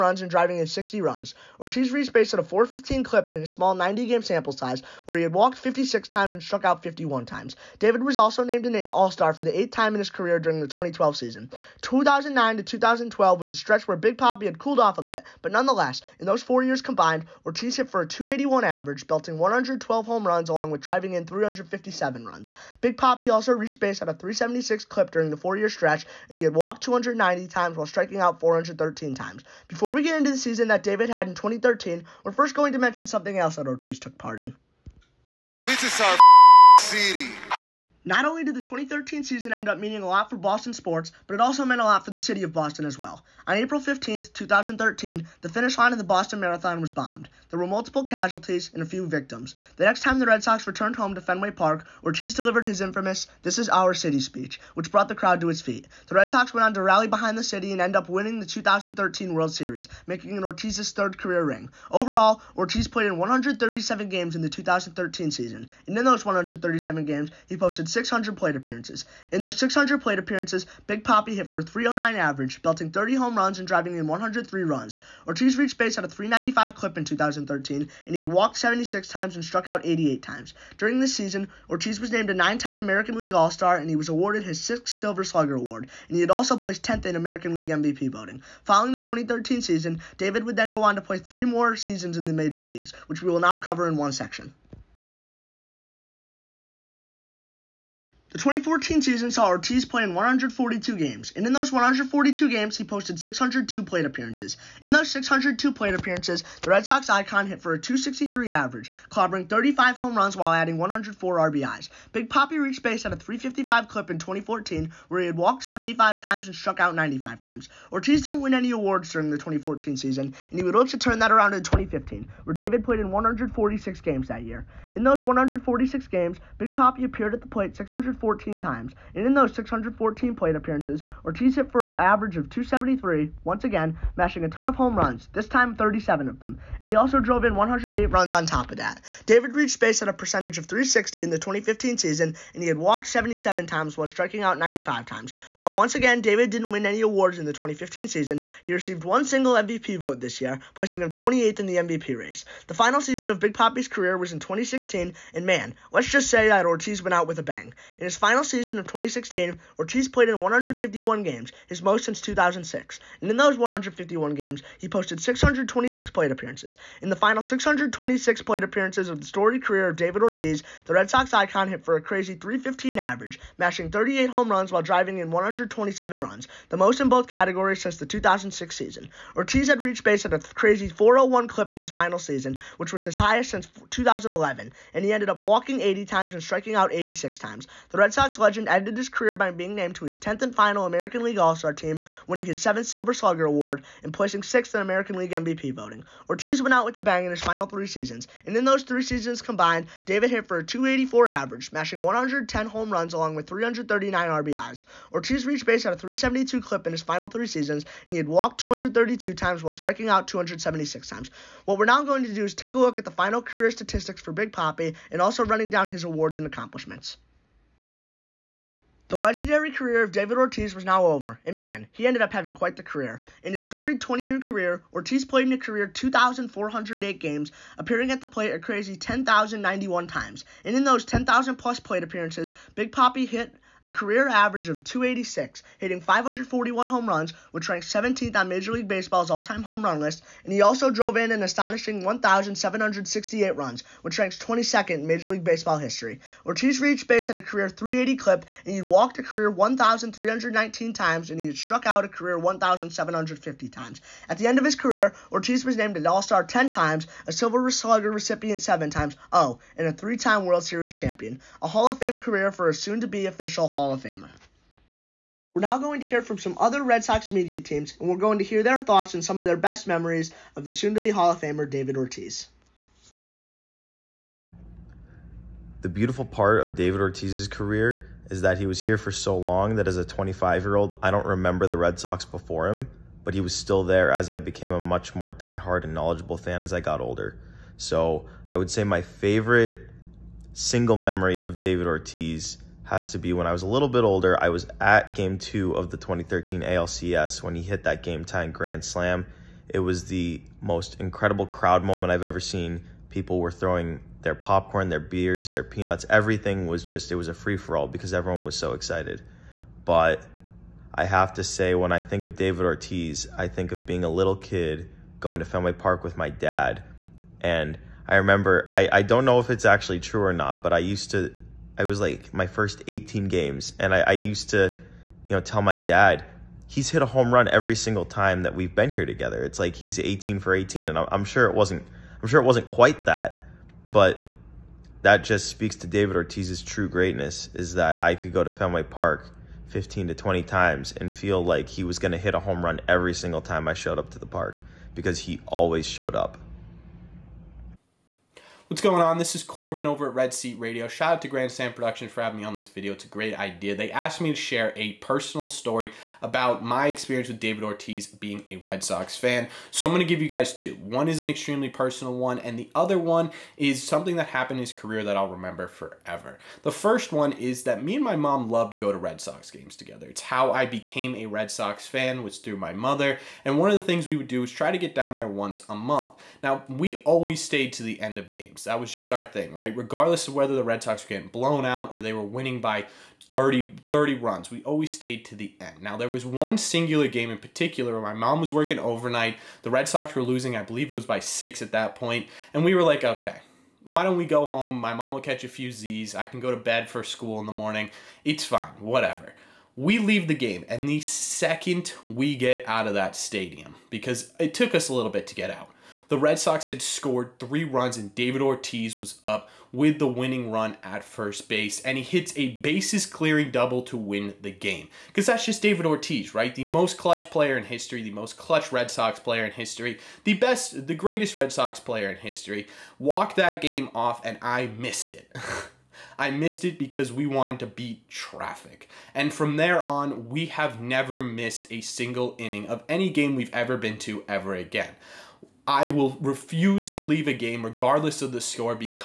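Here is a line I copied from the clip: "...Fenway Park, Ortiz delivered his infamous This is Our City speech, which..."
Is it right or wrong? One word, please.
right.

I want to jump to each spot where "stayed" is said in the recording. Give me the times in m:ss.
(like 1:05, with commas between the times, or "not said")
6:17, 6:24.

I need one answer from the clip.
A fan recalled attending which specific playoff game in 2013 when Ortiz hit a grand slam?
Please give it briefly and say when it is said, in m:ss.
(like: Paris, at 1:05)
Game 2 of the ALCS, at 4:55.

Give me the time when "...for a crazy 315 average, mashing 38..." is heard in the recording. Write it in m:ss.
2:51.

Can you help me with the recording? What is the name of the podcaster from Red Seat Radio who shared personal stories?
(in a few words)
Corbin.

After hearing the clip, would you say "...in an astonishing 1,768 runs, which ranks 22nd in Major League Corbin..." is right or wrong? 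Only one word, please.
wrong.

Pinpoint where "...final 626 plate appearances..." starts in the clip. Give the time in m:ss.
2:47.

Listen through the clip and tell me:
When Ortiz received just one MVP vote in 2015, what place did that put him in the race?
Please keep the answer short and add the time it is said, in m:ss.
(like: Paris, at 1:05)
28th, at 2:31.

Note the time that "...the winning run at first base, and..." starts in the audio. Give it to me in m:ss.
6:49.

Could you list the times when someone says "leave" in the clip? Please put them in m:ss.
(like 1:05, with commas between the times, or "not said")
6:39, 7:17.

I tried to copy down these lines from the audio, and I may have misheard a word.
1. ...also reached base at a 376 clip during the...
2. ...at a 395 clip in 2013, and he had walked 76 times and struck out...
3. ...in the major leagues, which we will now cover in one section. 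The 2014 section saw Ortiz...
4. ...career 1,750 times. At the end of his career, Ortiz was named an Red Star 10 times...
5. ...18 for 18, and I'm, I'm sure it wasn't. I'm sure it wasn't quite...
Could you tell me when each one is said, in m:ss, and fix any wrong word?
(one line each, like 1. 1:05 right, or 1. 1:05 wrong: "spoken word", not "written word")
1. 0:23 right
2. 1:15 right
3. 1:32 wrong: "season", not "section"
4. 4:12 wrong: "All", not "Red"
5. 5:29 right.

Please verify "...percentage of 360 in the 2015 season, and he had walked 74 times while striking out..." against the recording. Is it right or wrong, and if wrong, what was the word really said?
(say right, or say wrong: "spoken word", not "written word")
wrong: "77", not "74".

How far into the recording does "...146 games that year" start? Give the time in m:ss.
2:03.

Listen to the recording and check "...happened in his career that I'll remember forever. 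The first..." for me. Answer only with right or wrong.
right.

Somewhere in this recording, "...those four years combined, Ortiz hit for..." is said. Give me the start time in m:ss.
0:16.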